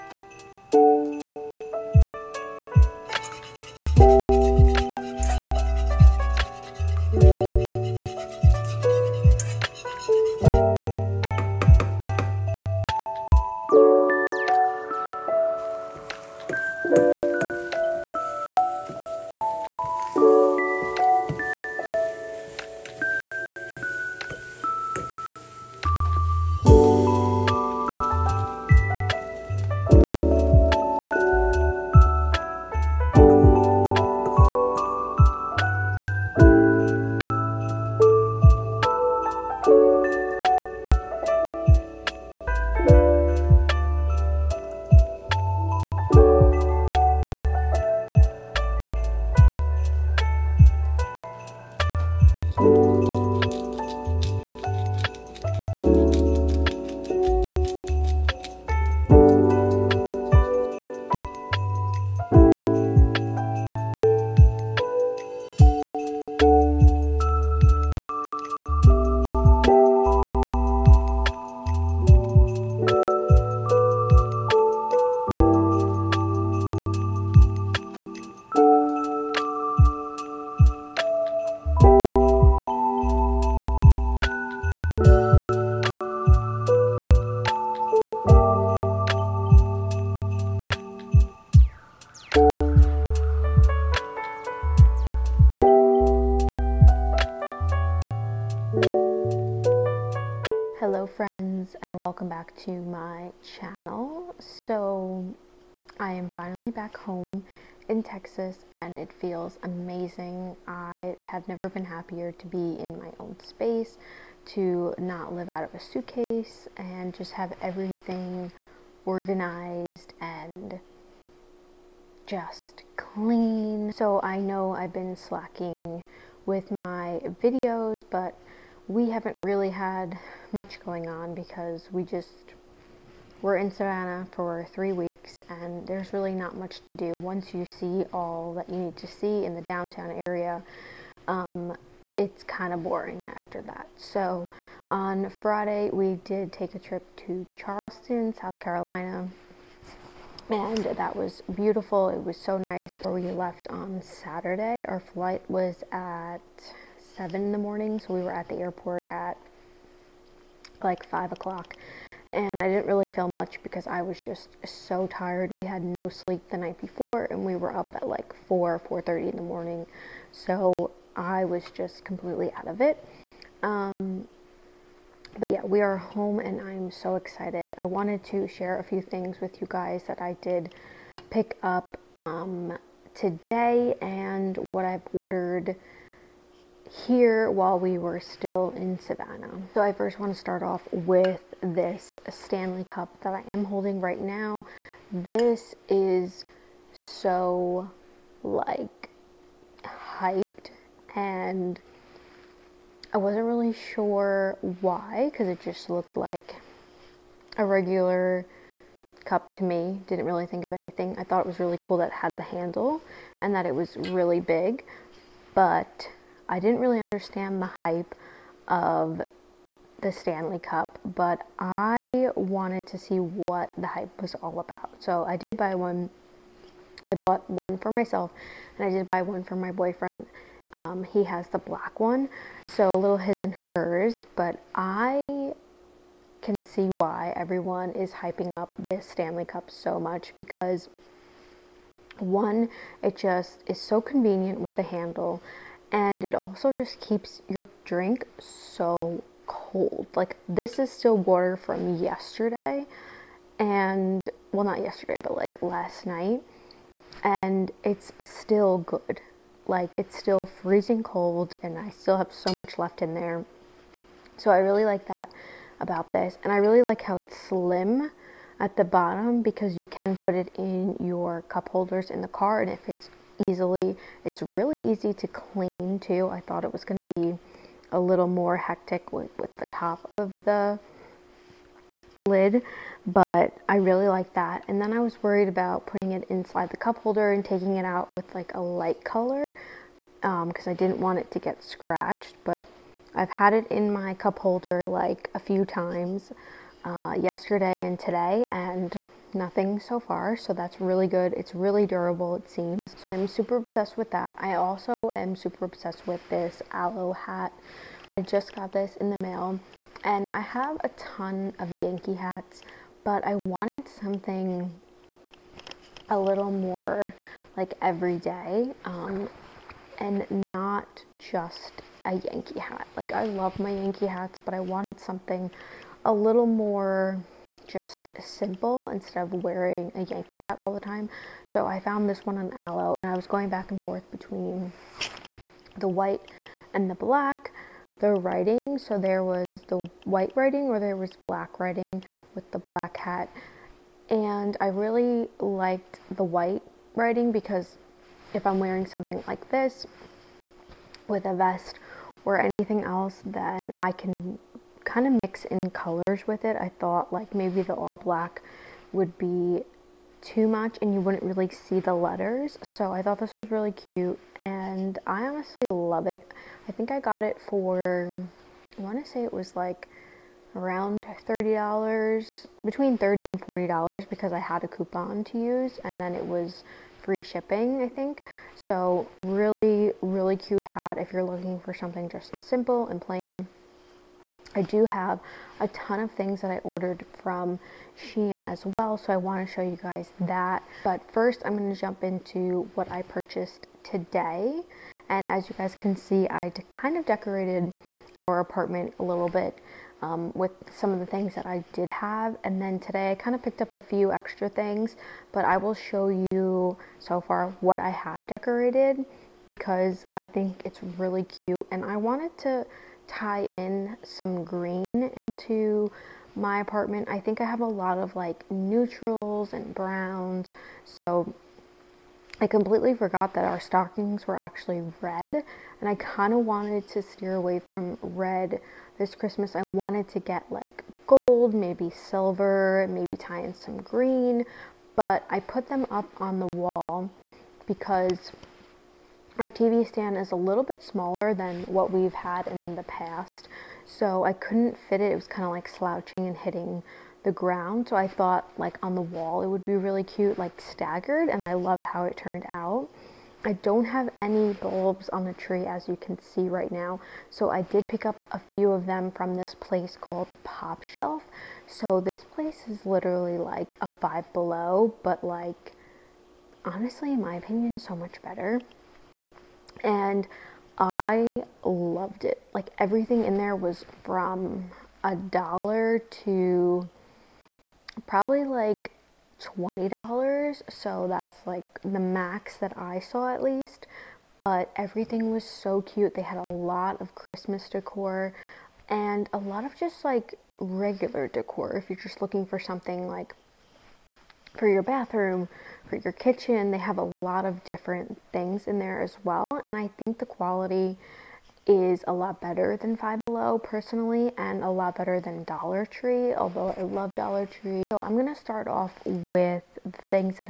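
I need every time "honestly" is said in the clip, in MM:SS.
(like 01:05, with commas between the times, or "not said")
06:05, 07:46.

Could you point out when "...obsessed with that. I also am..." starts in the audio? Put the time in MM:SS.
05:03.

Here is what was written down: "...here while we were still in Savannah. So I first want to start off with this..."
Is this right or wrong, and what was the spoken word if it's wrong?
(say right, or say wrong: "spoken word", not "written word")
right.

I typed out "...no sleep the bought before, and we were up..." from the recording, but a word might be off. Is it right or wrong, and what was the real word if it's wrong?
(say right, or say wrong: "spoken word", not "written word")
wrong: "night", not "bought".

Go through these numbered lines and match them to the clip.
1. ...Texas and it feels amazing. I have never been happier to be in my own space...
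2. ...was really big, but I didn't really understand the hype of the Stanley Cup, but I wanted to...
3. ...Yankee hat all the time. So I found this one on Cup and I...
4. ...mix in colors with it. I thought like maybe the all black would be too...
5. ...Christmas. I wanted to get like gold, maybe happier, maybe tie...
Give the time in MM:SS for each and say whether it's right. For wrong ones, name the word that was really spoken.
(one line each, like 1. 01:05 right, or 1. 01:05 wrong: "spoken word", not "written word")
1. 01:48 right
2. 03:33 right
3. 05:30 wrong: "Alo", not "Cup"
4. 05:55 right
5. 07:09 wrong: "silver", not "happier".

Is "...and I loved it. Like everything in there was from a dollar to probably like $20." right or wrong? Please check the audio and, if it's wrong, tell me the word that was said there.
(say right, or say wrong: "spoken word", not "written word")
right.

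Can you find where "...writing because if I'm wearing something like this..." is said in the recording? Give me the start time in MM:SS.
05:46.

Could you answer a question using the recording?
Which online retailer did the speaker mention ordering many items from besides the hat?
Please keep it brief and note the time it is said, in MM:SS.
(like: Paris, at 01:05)
Shein, at 06:27.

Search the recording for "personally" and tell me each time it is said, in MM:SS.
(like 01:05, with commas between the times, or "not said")
08:23.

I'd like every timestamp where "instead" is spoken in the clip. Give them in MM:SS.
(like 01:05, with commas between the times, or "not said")
05:28.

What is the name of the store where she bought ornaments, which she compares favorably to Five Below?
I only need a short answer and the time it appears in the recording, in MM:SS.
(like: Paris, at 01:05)
Popshelf, at 07:40.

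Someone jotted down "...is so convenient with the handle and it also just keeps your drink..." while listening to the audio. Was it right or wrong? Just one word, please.
right.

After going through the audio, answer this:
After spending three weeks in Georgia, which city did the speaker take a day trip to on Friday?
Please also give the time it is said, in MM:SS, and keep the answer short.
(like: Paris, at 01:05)
Charleston, at 02:27.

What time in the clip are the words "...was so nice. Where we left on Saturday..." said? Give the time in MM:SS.
02:32.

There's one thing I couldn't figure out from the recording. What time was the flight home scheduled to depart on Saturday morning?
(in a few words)
7 a.m.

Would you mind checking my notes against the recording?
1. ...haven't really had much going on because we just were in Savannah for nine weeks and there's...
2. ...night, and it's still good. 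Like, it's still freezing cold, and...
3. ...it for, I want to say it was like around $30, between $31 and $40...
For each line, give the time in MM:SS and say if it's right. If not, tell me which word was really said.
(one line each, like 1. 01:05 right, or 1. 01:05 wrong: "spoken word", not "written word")
1. 02:09 wrong: "three", not "nine"
2. 04:16 right
3. 06:07 wrong: "30", not "31".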